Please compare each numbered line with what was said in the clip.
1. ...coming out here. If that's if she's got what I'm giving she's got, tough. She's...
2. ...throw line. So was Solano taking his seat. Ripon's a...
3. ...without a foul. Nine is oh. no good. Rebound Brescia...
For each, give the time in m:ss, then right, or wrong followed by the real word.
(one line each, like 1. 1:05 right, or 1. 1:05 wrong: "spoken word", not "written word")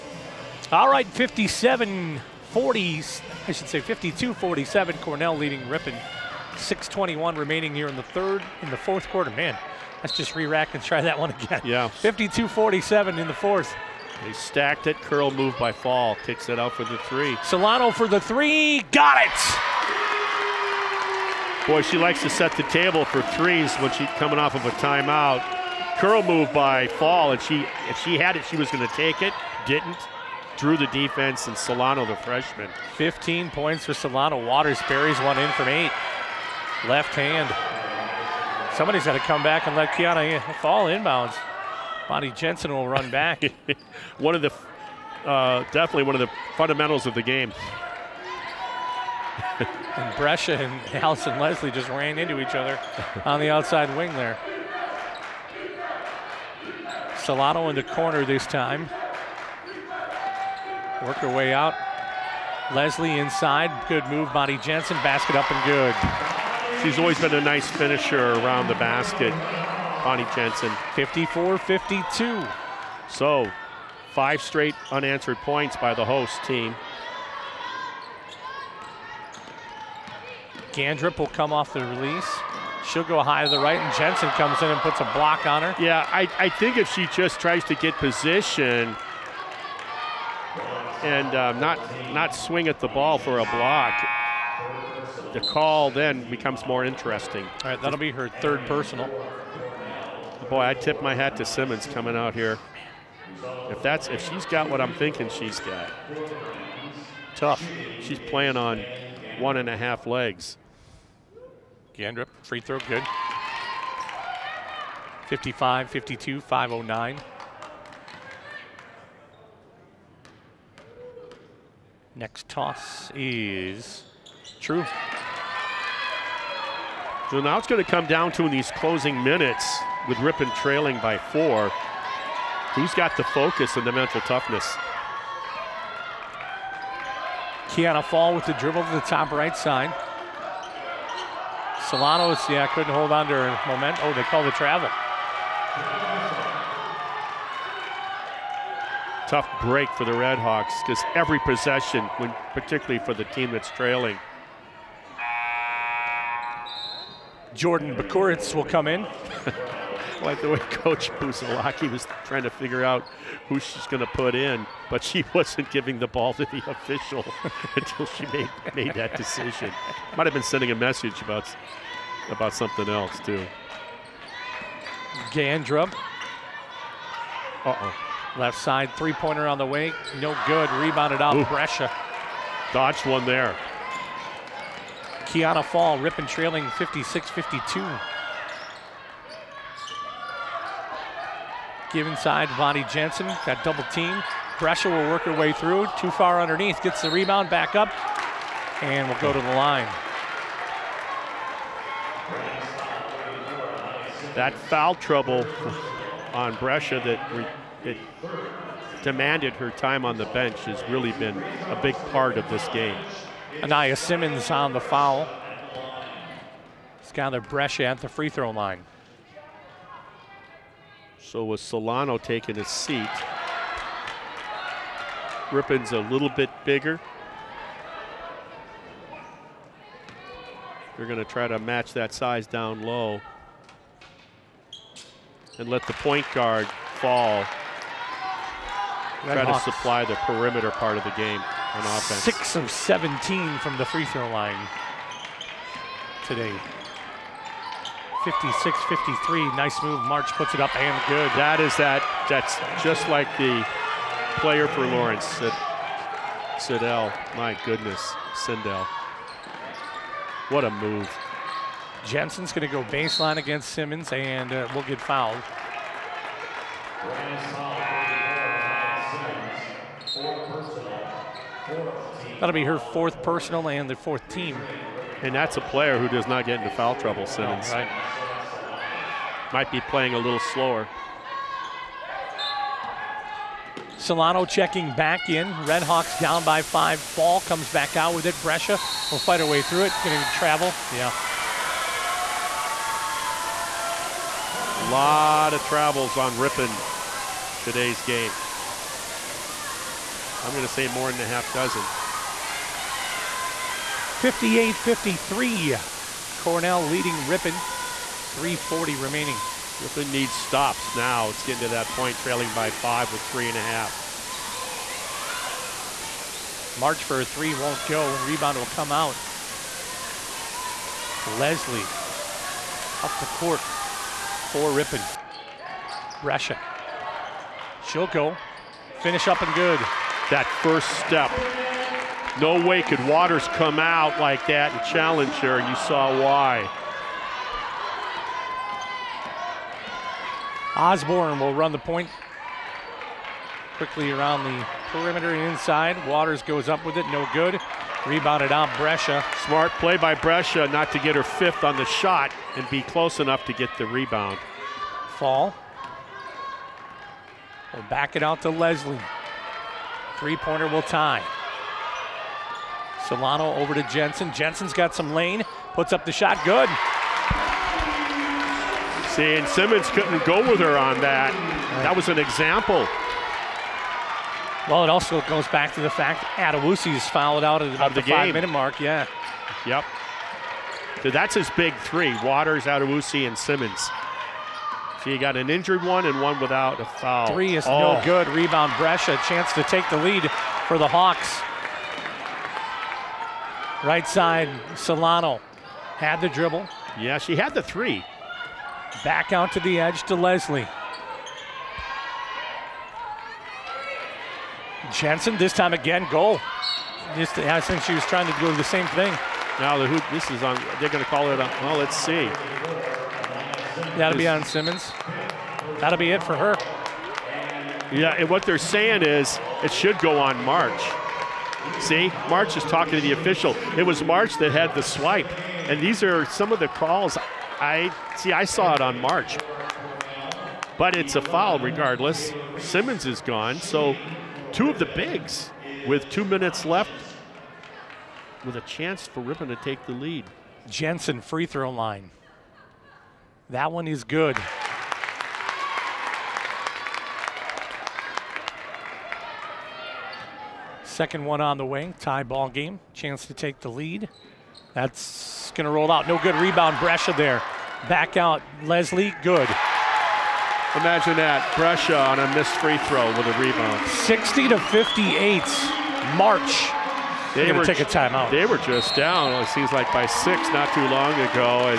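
1. 1:41 wrong: "thinking", not "giving"
2. 3:38 right
3. 6:26 wrong: "Three", not "Nine".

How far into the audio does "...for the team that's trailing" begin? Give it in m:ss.
2:32.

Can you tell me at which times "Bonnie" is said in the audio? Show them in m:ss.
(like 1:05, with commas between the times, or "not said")
0:42, 1:04, 1:10, 3:12.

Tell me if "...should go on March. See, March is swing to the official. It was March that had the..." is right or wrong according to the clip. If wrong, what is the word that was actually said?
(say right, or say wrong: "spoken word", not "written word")
wrong: "talking", not "swing".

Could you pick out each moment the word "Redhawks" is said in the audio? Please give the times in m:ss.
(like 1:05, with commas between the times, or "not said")
2:30, 4:45.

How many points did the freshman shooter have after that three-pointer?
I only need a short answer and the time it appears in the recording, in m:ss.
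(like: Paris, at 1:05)
15, at 0:32.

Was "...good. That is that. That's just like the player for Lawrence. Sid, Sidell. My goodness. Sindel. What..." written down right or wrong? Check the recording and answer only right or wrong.
right.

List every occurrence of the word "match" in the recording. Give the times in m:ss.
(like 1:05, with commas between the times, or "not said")
3:51.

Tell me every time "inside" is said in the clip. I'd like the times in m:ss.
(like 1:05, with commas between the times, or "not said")
1:03, 3:12, 5:45.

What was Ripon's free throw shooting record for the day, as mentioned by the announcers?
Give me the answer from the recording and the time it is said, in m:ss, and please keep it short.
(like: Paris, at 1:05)
6 of 17, at 4:02.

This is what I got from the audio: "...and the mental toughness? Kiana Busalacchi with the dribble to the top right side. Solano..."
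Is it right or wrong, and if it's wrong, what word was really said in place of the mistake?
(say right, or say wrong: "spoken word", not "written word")
wrong: "Fall", not "Busalacchi".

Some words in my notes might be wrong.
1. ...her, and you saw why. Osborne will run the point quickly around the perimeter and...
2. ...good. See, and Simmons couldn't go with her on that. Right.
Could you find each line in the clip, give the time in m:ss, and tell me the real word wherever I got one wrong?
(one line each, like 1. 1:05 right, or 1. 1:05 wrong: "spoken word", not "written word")
1. 5:35 right
2. 6:06 right.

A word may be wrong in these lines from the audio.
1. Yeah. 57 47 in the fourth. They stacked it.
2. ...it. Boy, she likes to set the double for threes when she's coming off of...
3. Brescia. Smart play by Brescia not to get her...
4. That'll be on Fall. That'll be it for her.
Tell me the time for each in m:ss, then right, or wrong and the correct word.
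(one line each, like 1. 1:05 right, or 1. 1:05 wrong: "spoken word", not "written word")
1. 0:11 wrong: "52", not "57"
2. 0:19 wrong: "table", not "double"
3. 5:48 right
4. 6:53 wrong: "Simmons", not "Fall".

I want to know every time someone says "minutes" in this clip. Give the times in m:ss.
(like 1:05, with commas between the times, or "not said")
2:09, 6:18, 7:16.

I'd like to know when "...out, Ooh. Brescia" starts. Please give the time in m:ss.
3:01.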